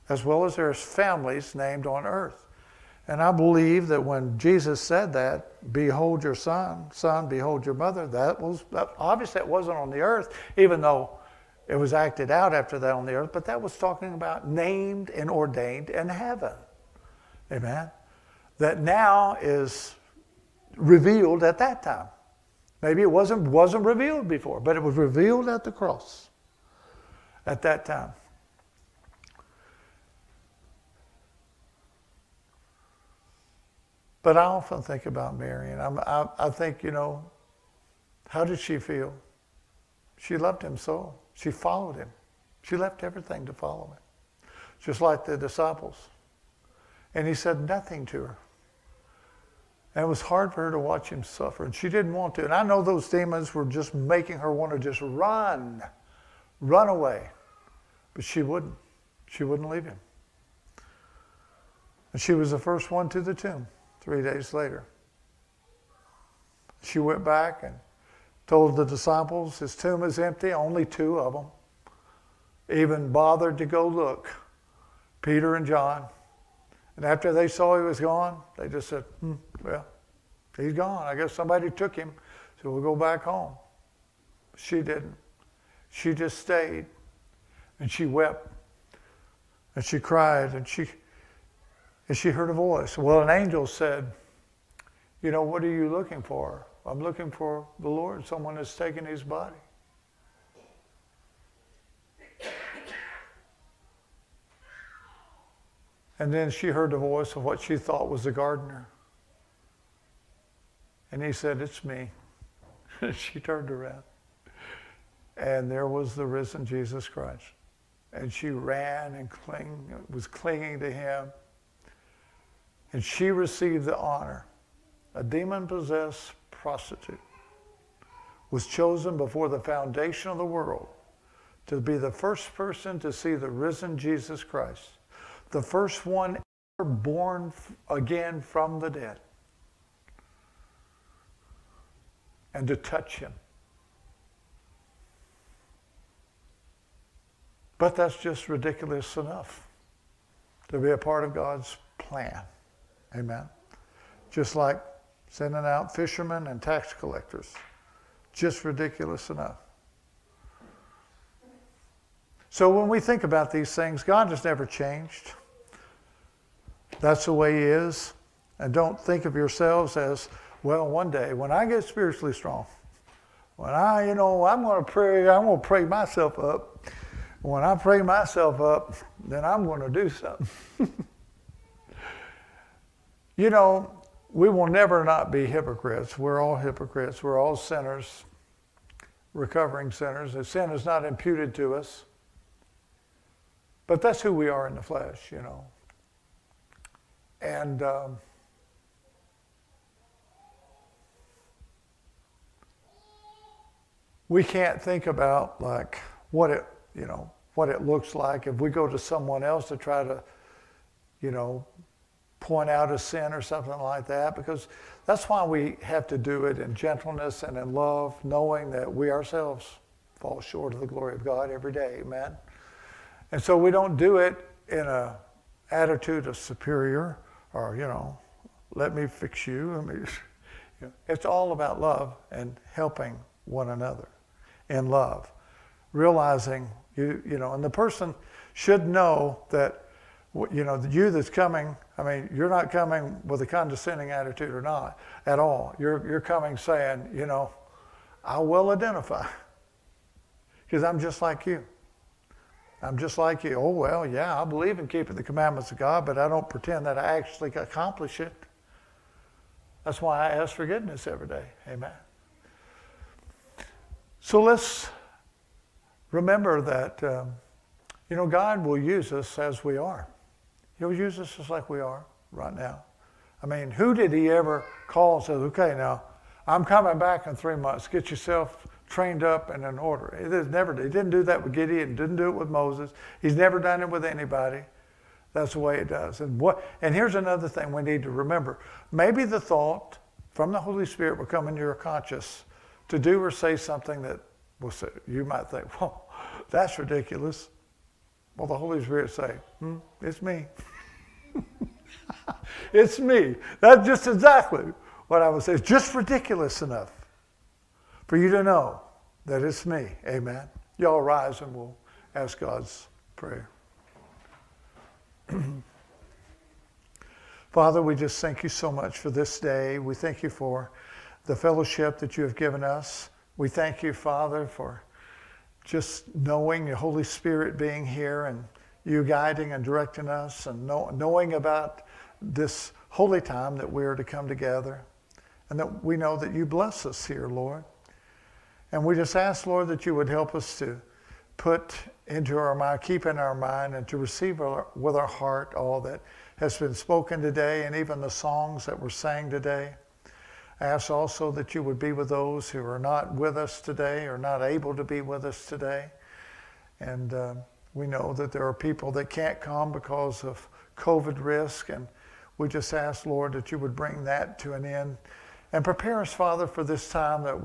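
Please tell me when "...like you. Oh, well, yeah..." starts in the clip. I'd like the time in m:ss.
4:13.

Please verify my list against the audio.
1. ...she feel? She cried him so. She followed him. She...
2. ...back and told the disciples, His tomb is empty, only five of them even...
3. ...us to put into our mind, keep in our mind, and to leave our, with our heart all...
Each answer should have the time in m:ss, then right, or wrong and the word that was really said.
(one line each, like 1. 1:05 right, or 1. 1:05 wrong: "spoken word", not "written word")
1. 0:38 wrong: "loved", not "cried"
2. 1:07 wrong: "two", not "five"
3. 5:40 wrong: "receive", not "leave".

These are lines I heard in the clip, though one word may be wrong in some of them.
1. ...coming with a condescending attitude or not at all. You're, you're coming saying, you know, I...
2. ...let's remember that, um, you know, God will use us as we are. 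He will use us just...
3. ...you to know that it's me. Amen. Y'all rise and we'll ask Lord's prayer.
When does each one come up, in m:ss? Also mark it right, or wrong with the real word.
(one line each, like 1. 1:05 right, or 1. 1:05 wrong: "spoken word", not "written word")
1. 4:02 right
2. 4:24 right
3. 5:08 wrong: "God", not "Lord".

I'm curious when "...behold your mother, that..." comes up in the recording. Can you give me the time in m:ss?
0:07.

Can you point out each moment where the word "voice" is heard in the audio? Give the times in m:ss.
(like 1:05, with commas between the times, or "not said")
1:32, 1:46.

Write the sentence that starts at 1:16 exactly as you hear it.
And after they saw he was gone, they just said, hmm, Well, he's gone.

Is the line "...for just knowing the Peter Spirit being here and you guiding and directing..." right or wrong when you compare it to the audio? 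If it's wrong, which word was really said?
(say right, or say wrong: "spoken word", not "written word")
wrong: "Holy", not "Peter".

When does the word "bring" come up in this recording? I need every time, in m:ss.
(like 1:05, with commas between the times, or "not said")
6:03.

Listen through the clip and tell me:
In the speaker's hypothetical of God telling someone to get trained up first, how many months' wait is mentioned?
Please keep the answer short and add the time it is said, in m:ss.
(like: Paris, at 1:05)
3, at 4:37.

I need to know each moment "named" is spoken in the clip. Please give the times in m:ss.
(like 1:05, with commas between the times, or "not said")
0:01, 0:14.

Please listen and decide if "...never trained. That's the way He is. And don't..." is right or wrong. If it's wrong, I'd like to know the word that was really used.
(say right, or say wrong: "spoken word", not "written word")
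wrong: "changed", not "trained".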